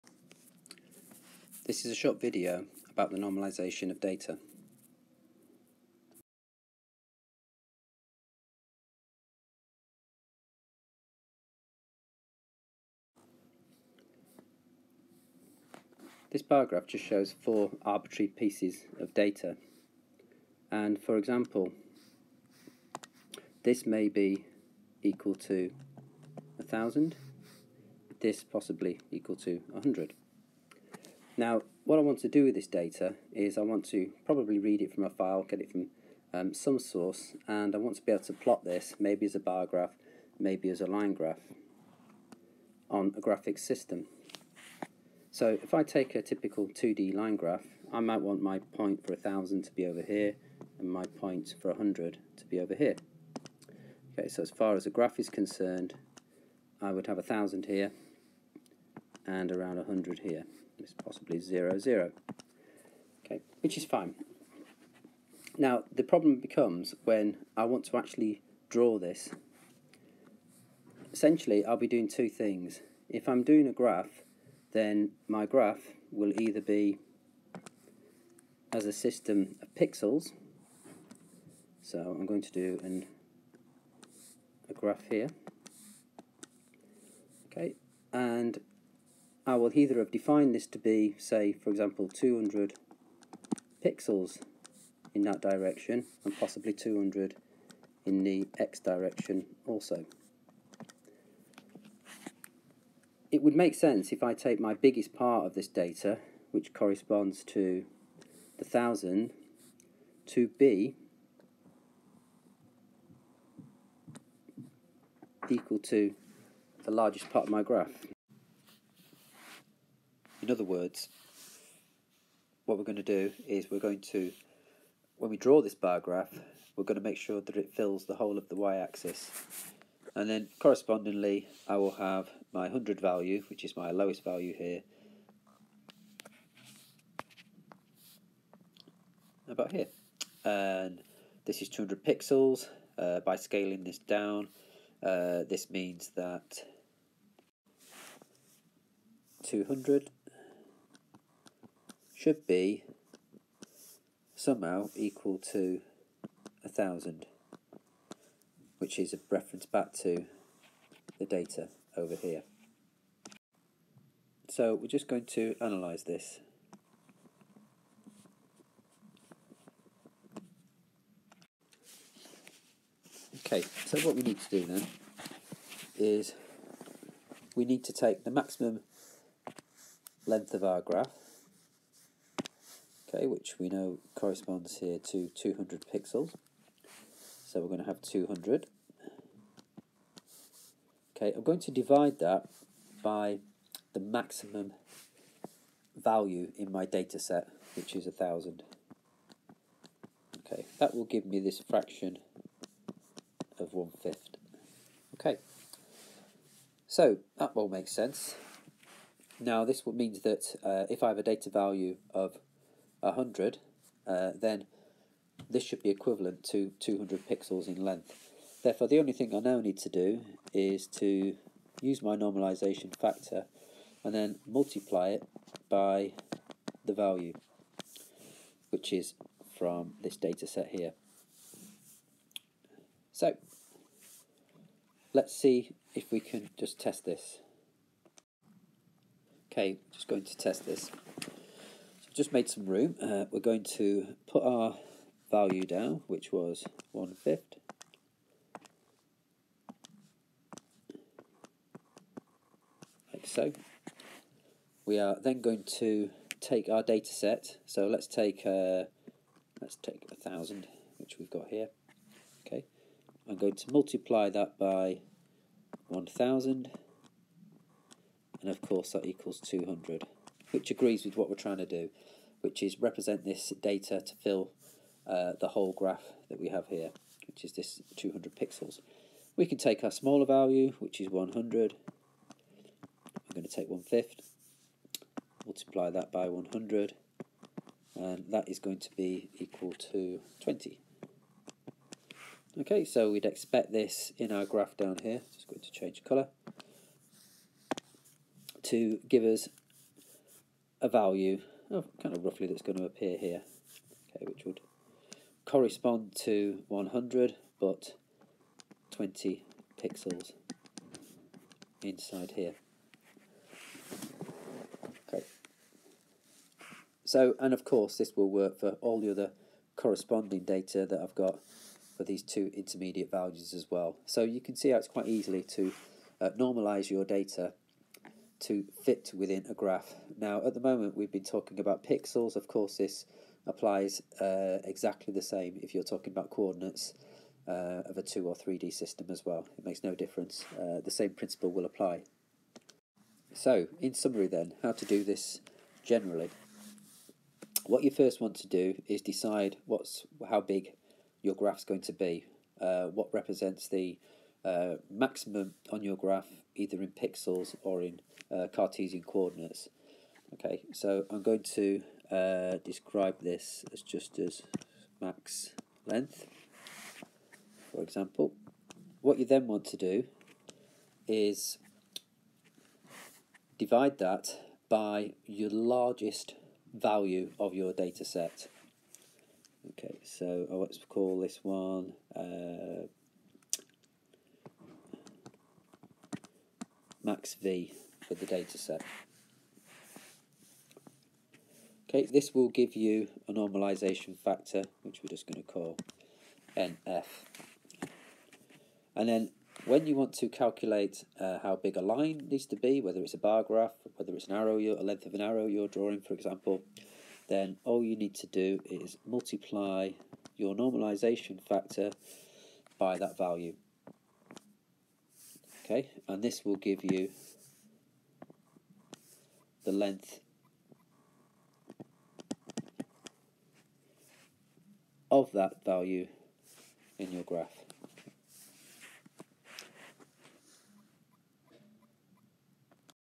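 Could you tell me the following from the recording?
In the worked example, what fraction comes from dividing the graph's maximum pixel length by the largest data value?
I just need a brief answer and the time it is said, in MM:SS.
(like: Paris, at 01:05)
one-fifth, at 03:23.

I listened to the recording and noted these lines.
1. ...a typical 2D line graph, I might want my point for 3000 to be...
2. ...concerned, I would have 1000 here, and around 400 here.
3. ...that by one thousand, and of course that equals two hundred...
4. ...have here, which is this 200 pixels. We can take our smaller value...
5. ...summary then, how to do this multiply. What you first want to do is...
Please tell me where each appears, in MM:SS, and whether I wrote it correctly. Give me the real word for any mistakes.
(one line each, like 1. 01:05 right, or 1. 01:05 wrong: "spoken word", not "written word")
1. 00:46 wrong: "1000", not "3000"
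2. 00:55 wrong: "100", not "400"
3. 04:24 right
4. 04:36 right
5. 05:43 wrong: "generally", not "multiply".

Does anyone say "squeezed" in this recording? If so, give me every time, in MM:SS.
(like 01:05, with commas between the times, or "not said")
not said.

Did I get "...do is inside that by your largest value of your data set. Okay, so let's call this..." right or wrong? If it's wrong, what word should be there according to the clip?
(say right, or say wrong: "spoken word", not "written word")
wrong: "divide", not "inside".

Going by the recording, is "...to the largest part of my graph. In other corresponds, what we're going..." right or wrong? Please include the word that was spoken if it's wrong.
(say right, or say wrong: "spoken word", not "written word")
wrong: "words", not "corresponds".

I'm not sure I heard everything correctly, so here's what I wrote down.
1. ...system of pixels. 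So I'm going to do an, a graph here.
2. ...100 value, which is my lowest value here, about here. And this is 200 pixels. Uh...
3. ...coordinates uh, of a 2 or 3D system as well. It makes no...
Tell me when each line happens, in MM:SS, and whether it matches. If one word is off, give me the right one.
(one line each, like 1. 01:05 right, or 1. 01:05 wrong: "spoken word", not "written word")
1. 01:18 right
2. 02:12 right
3. 05:36 right.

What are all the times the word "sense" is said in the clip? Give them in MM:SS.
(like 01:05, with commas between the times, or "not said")
01:43, 03:27.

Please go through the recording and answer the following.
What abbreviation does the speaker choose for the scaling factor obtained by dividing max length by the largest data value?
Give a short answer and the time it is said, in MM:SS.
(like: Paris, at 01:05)
NF, at 06:36.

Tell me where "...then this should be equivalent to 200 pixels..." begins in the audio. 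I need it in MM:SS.
03:34.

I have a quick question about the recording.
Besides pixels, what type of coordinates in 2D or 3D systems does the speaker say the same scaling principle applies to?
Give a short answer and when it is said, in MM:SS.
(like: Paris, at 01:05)
Cartesian, at 05:58.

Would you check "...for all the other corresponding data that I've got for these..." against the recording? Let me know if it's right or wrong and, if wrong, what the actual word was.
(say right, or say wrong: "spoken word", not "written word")
right.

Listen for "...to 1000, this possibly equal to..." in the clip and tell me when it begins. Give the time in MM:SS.
00:25.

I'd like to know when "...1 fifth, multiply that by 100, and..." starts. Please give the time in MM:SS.
04:43.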